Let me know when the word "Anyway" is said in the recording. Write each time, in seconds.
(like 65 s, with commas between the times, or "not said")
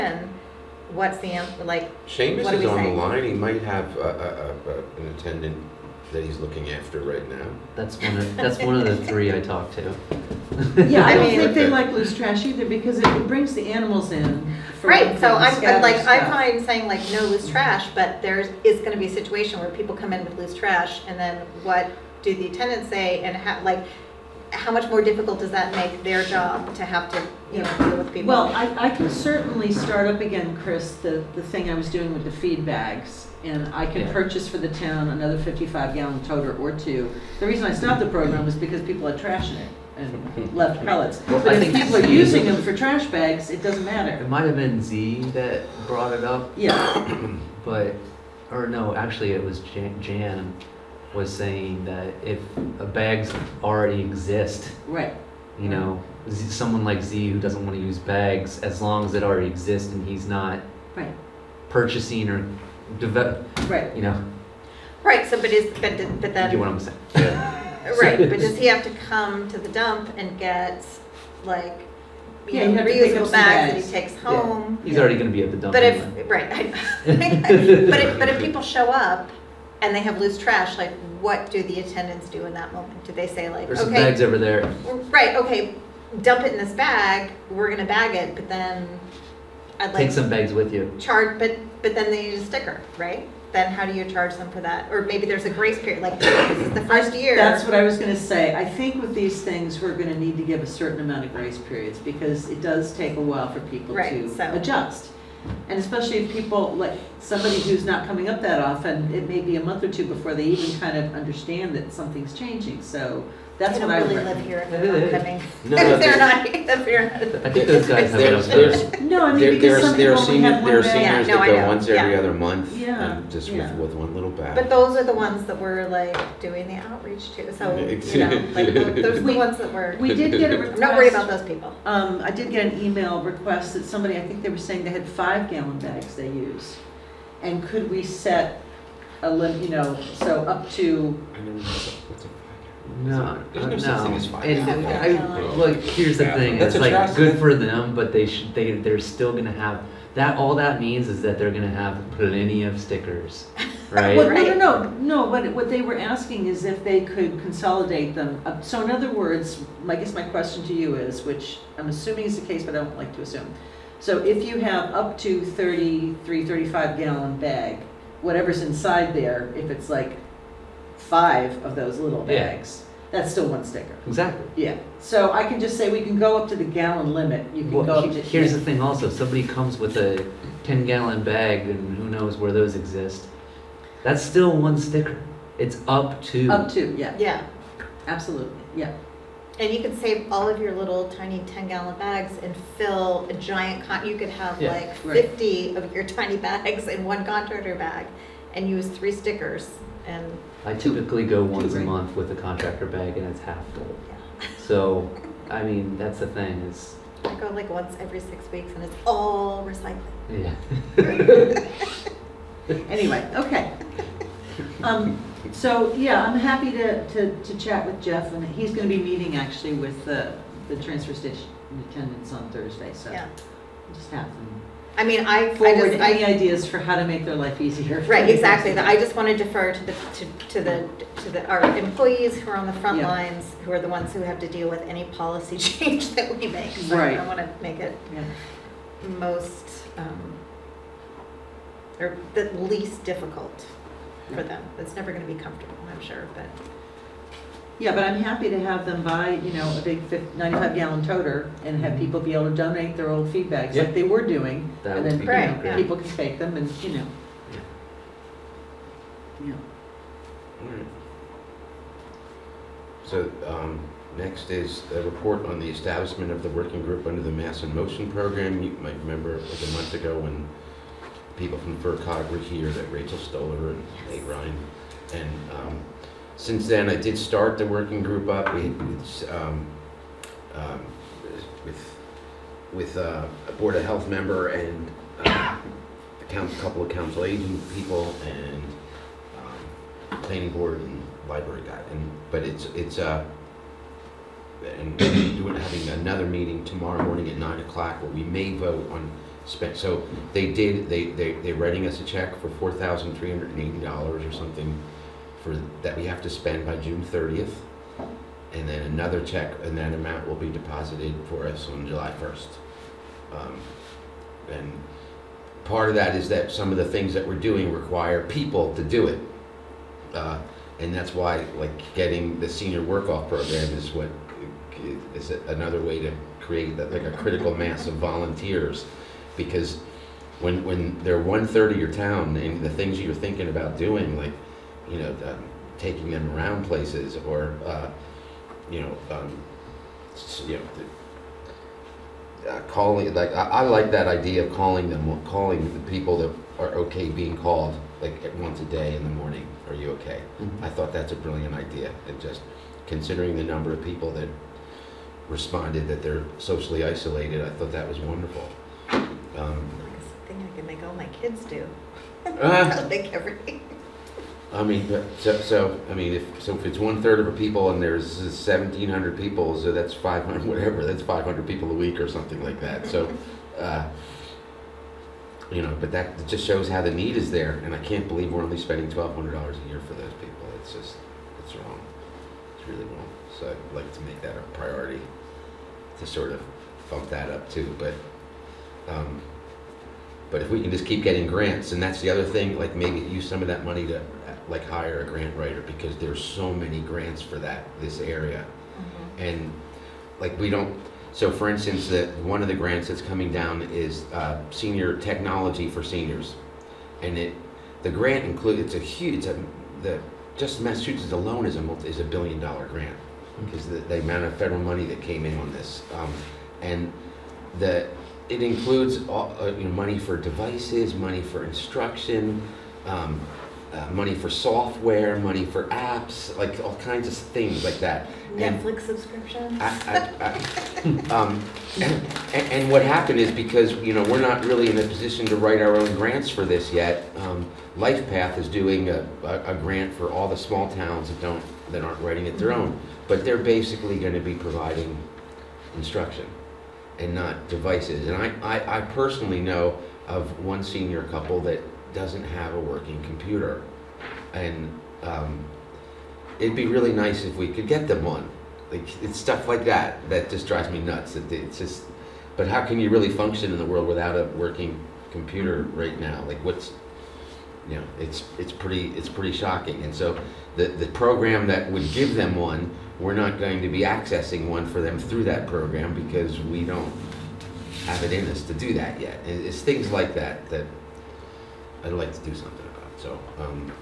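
212 s.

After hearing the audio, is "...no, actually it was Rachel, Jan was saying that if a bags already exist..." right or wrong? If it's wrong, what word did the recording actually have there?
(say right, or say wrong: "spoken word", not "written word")
wrong: "Jan", not "Rachel".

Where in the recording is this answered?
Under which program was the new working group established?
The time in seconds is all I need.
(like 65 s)
267 s.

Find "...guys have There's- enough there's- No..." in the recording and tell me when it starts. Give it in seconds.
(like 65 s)
117 s.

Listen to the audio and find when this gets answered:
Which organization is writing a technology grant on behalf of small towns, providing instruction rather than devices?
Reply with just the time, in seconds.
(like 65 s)
437 s.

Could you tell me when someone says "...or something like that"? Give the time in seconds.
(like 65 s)
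372 s.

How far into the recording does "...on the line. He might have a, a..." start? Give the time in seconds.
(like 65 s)
2 s.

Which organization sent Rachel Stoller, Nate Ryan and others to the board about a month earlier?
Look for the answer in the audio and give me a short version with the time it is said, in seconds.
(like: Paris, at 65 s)
FRCOG, at 271 s.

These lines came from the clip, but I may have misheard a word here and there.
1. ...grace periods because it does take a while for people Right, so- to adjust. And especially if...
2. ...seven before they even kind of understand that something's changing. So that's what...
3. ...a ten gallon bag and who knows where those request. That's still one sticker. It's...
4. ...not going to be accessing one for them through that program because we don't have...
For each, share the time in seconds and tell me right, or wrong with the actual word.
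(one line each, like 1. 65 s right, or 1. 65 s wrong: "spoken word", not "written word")
1. 101 s right
2. 109 s wrong: "two", not "seven"
3. 179 s wrong: "exist", not "request"
4. 473 s right.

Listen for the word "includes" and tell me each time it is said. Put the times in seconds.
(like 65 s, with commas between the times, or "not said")
408 s, 418 s.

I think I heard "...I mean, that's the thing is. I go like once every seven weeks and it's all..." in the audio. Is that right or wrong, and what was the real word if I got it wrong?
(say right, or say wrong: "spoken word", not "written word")
wrong: "six", not "seven".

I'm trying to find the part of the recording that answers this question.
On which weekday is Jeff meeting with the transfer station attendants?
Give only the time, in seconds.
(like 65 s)
222 s.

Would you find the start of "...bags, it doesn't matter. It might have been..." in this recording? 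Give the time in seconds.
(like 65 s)
43 s.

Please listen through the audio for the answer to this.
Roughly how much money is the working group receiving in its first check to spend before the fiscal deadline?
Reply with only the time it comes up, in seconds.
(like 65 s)
302 s.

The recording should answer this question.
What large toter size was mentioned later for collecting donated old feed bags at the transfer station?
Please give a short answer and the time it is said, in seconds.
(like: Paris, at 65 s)
95 gallon, at 250 s.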